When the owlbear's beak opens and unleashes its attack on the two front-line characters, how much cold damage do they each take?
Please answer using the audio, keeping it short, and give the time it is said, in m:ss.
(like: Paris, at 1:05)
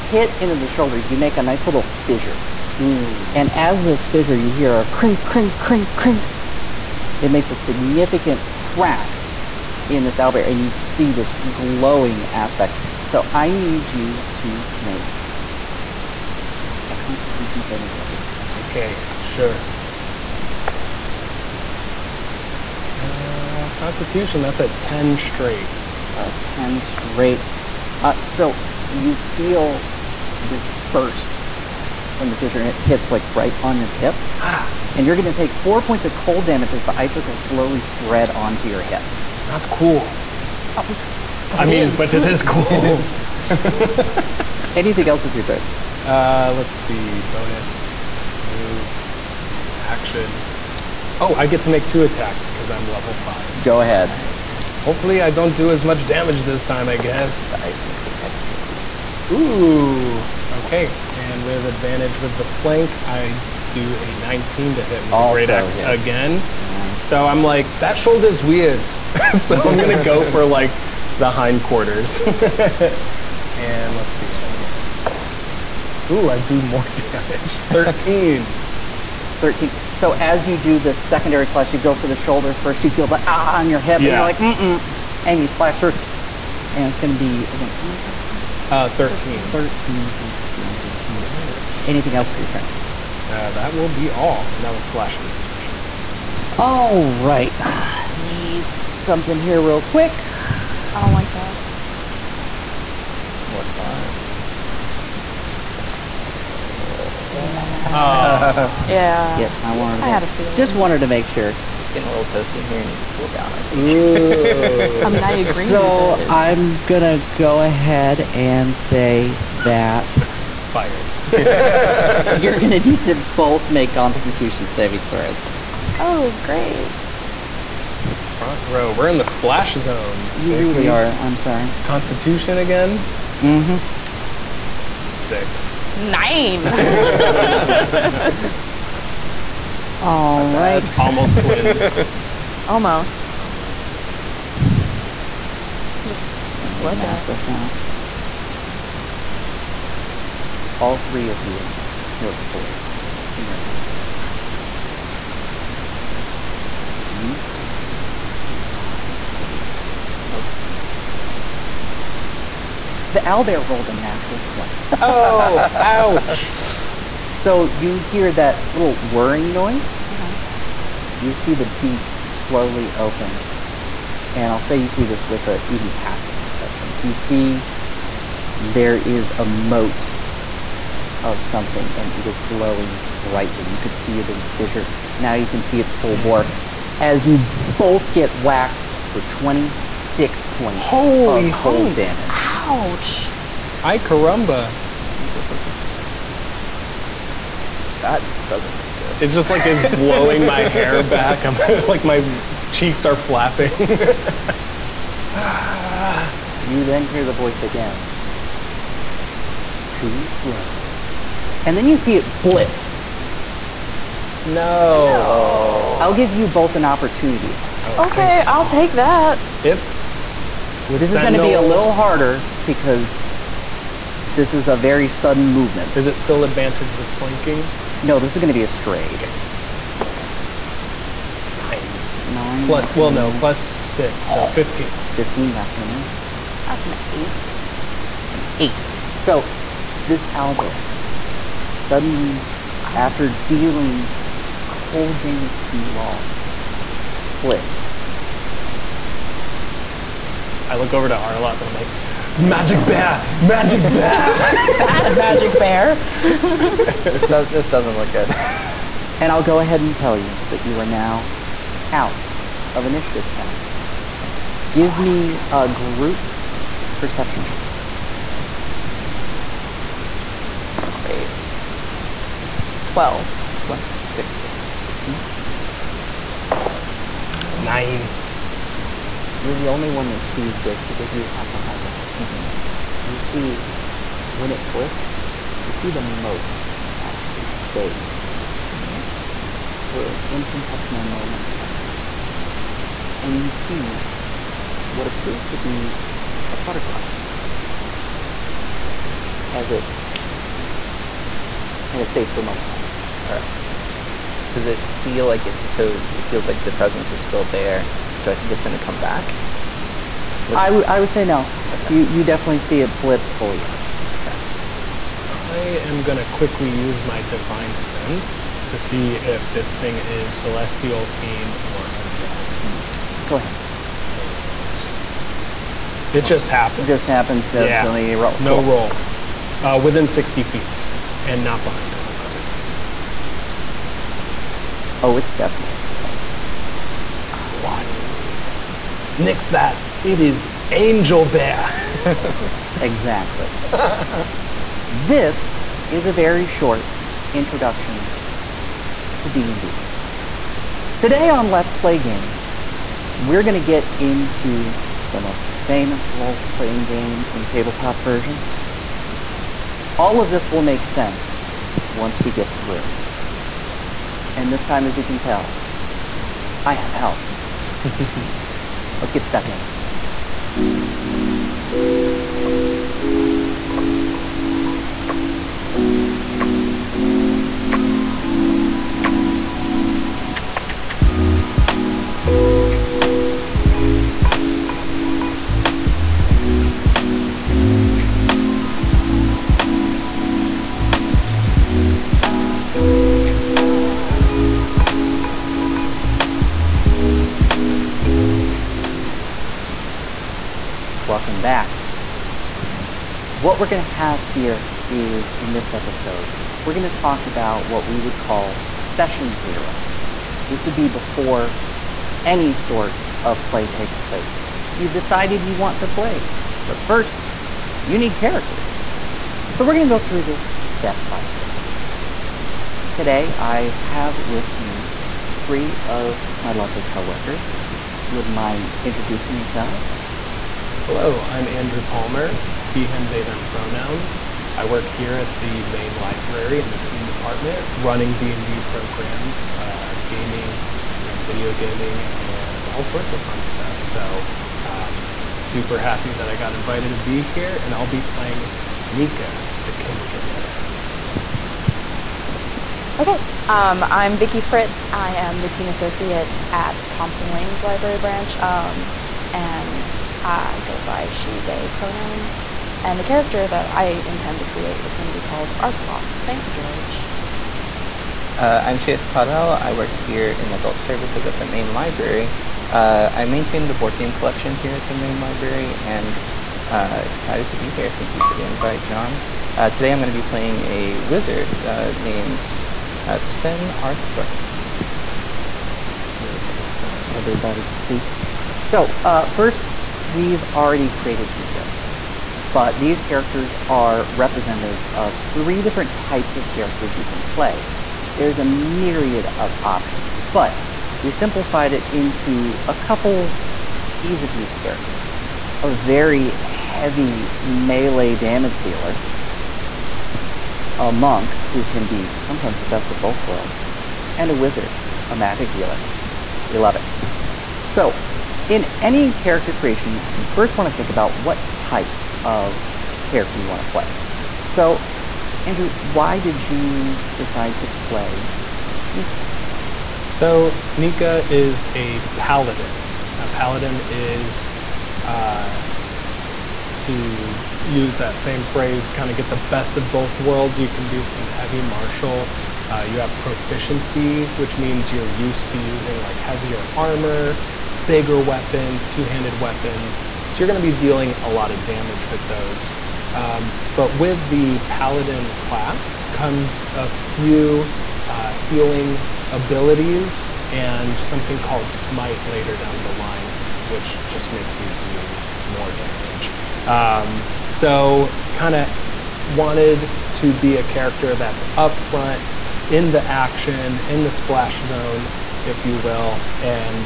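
26, at 3:09.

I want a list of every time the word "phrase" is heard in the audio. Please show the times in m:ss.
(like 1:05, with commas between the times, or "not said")
8:58.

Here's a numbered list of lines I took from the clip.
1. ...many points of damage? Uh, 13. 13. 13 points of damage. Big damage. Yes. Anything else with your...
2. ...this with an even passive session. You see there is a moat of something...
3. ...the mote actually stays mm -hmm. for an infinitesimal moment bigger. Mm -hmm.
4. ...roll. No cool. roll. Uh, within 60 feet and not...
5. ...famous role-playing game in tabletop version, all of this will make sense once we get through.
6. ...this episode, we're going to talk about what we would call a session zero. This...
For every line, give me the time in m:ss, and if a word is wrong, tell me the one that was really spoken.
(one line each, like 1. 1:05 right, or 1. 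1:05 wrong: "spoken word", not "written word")
1. 1:27 right
2. 2:55 wrong: "perception", not "session"
3. 4:45 wrong: "longer", not "bigger"
4. 5:28 right
5. 5:55 right
6. 6:45 right.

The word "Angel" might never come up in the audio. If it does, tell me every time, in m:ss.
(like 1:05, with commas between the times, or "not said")
5:40.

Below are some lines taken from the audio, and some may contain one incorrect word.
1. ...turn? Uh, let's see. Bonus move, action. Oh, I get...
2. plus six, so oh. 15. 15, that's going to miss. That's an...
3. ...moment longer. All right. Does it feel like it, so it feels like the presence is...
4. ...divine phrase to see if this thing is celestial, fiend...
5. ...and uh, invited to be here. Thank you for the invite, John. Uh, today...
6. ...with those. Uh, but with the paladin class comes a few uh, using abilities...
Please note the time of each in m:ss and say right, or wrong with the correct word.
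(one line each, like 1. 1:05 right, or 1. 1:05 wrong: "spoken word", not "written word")
1. 0:45 right
2. 3:53 right
3. 5:02 right
4. 5:17 wrong: "sense", not "phrase"
5. 7:55 wrong: "excited", not "invited"
6. 9:12 wrong: "healing", not "using".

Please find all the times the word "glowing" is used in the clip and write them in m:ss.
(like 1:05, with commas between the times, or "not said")
0:11, 3:02.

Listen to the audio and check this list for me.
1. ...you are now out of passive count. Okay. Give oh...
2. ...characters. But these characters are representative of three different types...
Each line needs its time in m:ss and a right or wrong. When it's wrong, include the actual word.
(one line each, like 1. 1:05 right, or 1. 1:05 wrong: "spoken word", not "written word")
1. 4:20 wrong: "initiative", not "passive"
2. 8:11 right.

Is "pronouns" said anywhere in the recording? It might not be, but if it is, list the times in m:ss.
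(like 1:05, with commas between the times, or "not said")
7:13, 7:41.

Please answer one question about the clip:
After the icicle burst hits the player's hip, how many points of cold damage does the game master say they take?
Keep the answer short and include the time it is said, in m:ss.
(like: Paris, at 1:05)
4, at 0:35.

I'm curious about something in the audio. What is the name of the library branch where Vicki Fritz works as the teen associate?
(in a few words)
Thompson Lanes.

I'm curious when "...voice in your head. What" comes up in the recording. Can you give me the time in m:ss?
2:32.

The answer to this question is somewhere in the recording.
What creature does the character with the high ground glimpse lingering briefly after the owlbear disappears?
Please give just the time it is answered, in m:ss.
4:56.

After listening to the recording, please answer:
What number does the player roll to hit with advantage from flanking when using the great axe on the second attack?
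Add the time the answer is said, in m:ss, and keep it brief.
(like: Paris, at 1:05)
19, at 1:04.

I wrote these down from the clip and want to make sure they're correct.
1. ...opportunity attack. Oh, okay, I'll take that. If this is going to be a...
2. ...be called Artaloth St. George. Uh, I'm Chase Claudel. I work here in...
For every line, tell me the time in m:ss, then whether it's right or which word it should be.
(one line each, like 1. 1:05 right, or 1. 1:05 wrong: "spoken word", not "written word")
1. 3:36 right
2. 7:45 right.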